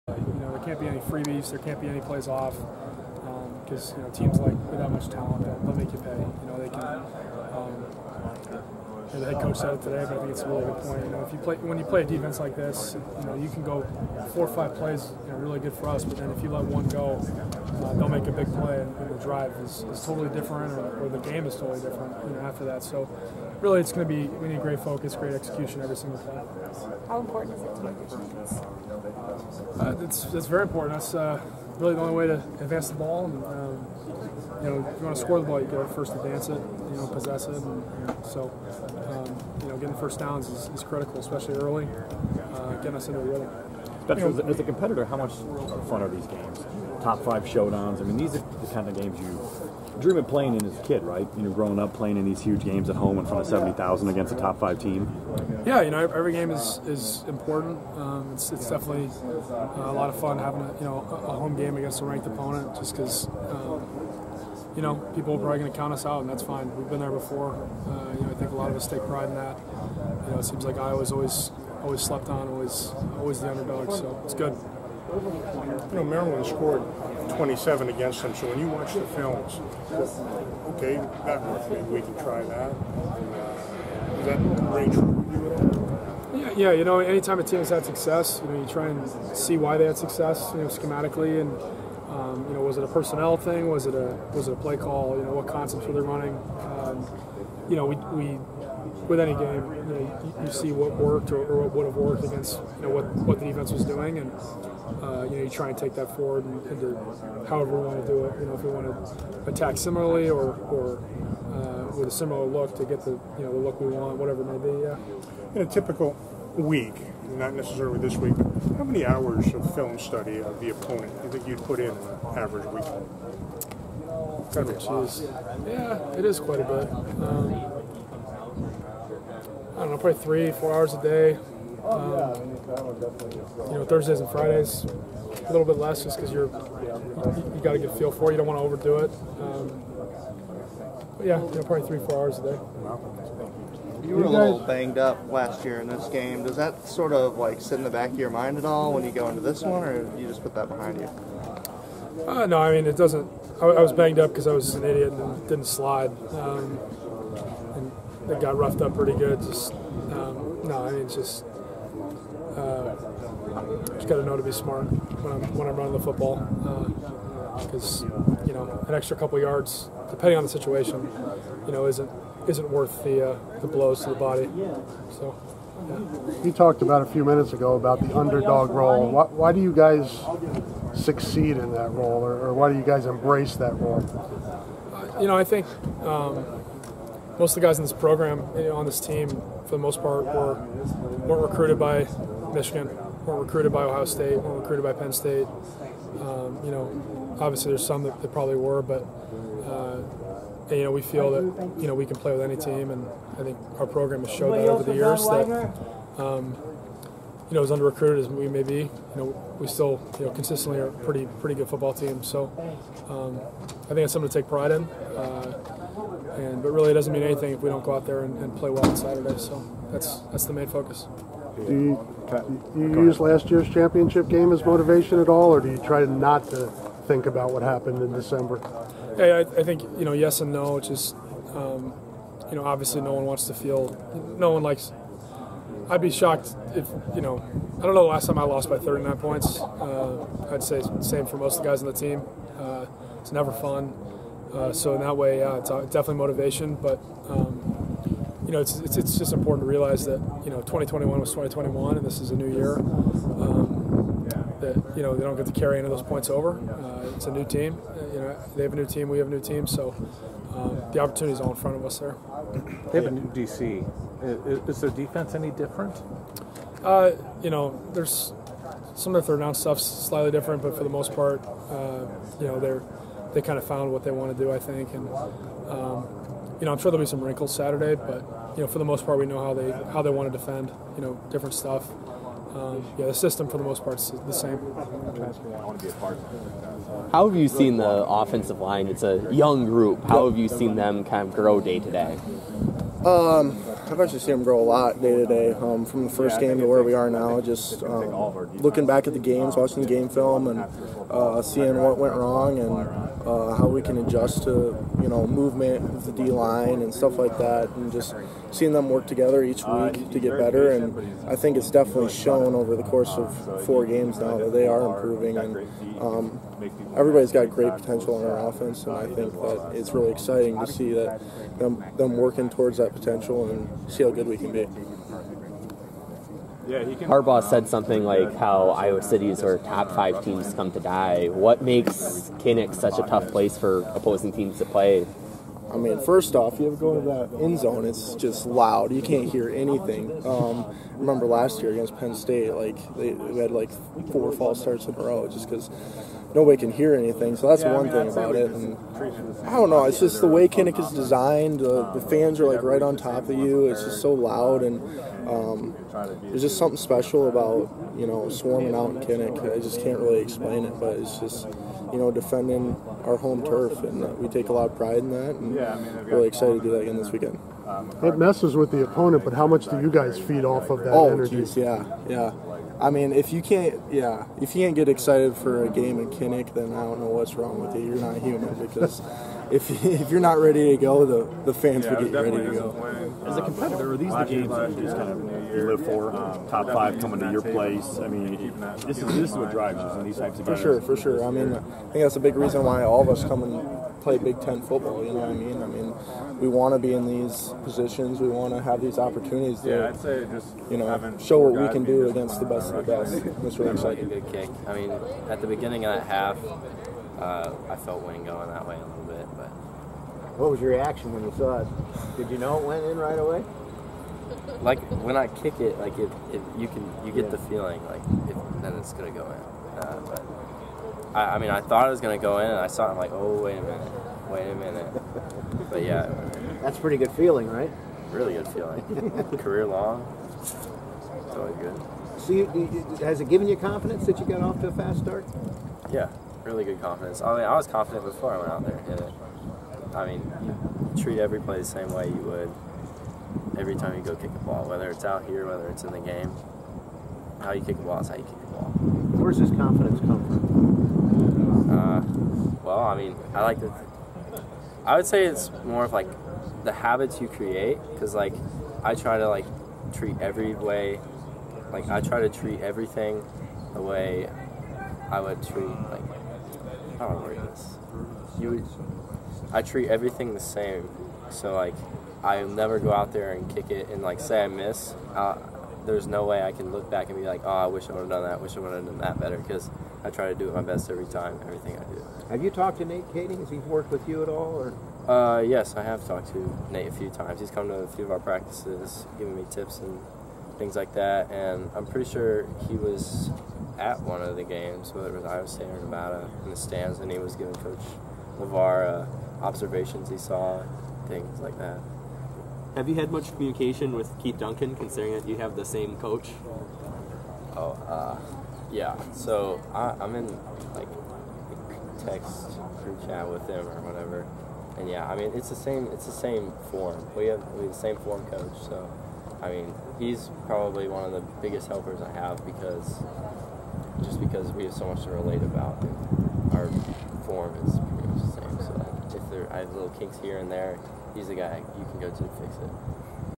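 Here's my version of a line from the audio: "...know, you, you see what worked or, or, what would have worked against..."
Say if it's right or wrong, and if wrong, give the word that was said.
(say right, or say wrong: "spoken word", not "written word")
right.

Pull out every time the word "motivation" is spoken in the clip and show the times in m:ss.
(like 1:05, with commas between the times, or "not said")
3:44, 4:06.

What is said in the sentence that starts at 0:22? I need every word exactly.
You know, after that, so really it's going to be we need great focus, great execution every single play.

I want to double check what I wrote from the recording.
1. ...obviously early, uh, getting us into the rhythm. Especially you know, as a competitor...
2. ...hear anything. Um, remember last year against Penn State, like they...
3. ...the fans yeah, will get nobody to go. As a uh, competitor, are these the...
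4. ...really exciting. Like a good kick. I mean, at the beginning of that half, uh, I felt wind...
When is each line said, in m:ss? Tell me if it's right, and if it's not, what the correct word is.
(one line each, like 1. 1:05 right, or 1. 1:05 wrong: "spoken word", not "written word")
1. 0:41 wrong: "especially", not "obviously"
2. 5:39 right
3. 6:21 wrong: "ready", not "nobody"
4. 6:43 right.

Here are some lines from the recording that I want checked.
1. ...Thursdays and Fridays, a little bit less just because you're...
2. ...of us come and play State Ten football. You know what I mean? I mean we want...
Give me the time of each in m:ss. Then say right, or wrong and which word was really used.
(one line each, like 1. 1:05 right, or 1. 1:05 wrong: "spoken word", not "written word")
1. 2:13 right
2. 6:33 wrong: "Big", not "State".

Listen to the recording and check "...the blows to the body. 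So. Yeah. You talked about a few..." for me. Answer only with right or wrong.
right.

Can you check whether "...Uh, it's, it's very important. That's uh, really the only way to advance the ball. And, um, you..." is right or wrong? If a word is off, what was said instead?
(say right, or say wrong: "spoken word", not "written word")
right.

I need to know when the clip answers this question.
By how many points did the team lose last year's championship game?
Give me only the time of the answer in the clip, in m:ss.
3:58.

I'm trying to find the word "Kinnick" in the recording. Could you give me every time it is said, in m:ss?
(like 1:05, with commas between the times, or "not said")
5:32, 5:50, 5:59, 6:16.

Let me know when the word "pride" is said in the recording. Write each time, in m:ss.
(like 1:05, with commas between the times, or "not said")
1:09, 3:34, 6:04.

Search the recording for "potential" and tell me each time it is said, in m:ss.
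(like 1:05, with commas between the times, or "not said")
5:17, 5:22.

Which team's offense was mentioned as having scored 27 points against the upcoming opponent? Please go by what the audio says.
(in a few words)
Maryland.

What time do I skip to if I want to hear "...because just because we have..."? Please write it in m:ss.
8:42.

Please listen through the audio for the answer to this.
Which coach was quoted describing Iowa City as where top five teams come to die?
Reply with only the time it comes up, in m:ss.
5:27.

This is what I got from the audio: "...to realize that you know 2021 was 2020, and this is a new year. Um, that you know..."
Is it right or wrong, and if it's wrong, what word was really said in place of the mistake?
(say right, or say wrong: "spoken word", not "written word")
wrong: "2021", not "2020".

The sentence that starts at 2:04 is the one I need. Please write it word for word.
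Kind of yeah, it is quite a bit.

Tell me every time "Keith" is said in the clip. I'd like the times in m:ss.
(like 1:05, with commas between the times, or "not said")
8:24.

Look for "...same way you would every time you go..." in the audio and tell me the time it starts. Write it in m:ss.
7:21.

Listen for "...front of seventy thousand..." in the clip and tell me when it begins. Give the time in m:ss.
0:53.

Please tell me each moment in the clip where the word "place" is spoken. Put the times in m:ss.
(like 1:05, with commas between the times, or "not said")
5:33, 6:27.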